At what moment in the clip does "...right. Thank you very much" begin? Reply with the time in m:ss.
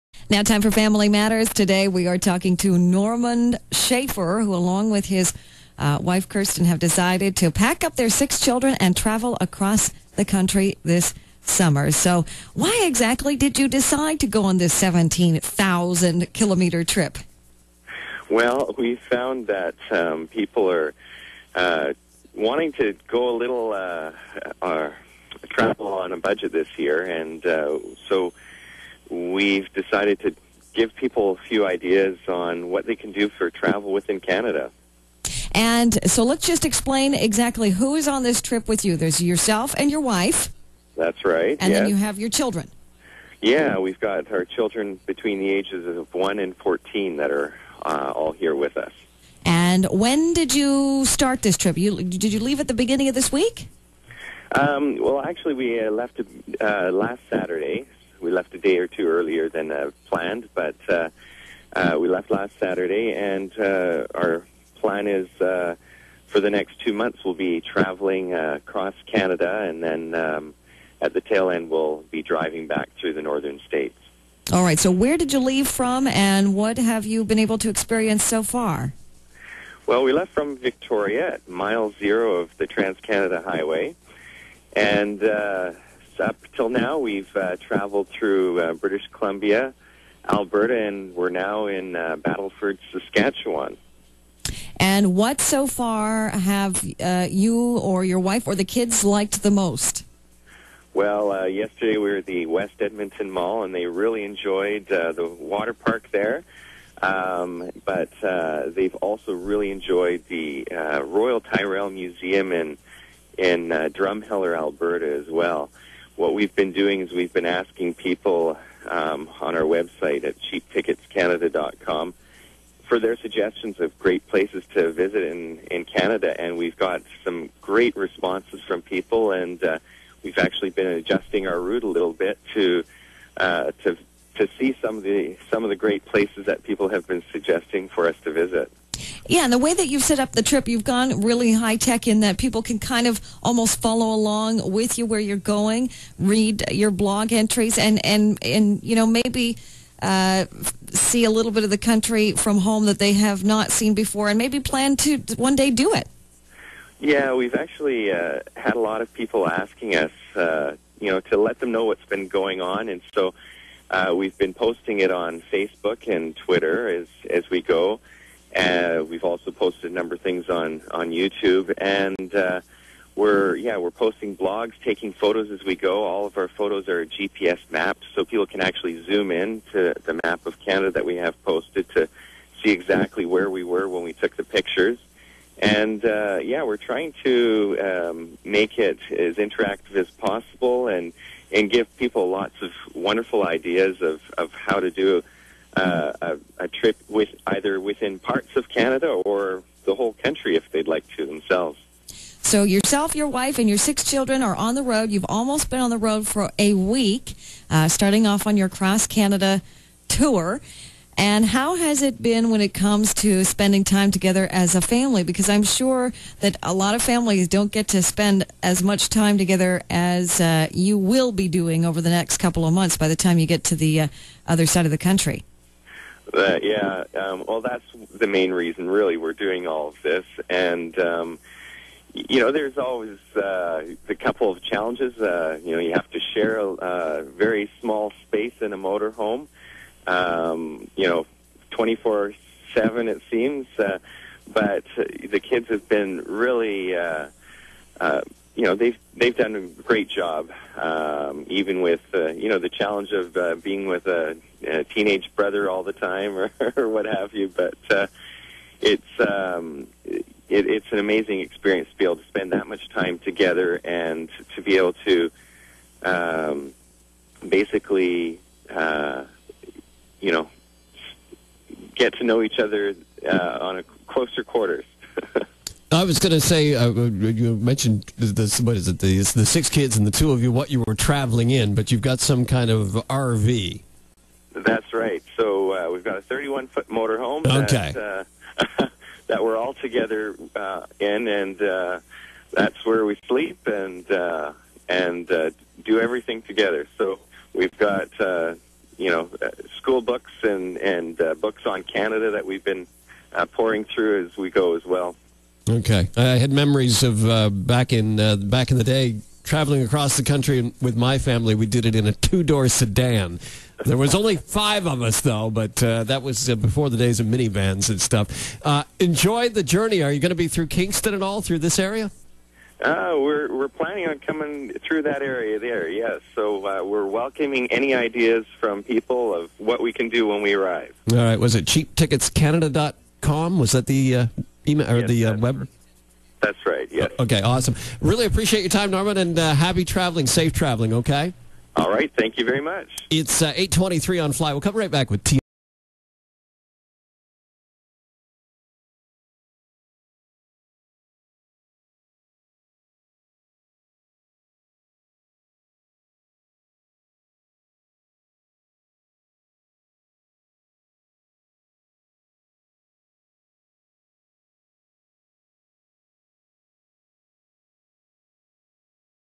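5:41.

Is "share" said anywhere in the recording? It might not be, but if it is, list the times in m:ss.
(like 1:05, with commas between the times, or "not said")
3:56.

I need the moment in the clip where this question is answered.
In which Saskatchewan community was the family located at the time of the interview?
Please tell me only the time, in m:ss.
1:32.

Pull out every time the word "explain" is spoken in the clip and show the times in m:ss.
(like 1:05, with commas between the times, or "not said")
0:36.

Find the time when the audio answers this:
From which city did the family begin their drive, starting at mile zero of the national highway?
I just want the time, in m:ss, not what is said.
1:20.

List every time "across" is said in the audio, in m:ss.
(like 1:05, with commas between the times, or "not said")
0:09, 1:08, 5:09.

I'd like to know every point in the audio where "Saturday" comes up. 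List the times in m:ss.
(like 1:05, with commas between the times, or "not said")
0:57, 1:02.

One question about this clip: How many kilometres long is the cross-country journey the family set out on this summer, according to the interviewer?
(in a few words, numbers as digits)
17,000.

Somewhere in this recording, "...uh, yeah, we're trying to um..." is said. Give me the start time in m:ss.
3:06.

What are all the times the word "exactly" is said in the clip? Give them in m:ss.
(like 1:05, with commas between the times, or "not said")
0:12, 0:37, 3:02.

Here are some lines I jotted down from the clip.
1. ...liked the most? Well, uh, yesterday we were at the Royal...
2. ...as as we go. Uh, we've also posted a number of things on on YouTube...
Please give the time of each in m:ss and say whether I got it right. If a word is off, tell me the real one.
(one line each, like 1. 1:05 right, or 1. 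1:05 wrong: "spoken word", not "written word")
1. 1:39 wrong: "West", not "Royal"
2. 2:46 right.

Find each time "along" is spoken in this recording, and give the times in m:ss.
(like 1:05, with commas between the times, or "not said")
0:04, 2:24.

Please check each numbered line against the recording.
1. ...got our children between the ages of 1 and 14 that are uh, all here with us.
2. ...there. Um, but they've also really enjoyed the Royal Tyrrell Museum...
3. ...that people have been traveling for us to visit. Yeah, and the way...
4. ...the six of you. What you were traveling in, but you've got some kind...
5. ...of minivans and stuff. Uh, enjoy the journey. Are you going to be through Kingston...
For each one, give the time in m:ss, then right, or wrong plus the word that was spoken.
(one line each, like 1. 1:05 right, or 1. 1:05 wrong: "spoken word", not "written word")
1. 0:43 right
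2. 1:46 right
3. 2:16 wrong: "suggesting", not "traveling"
4. 4:40 wrong: "two", not "six"
5. 5:17 right.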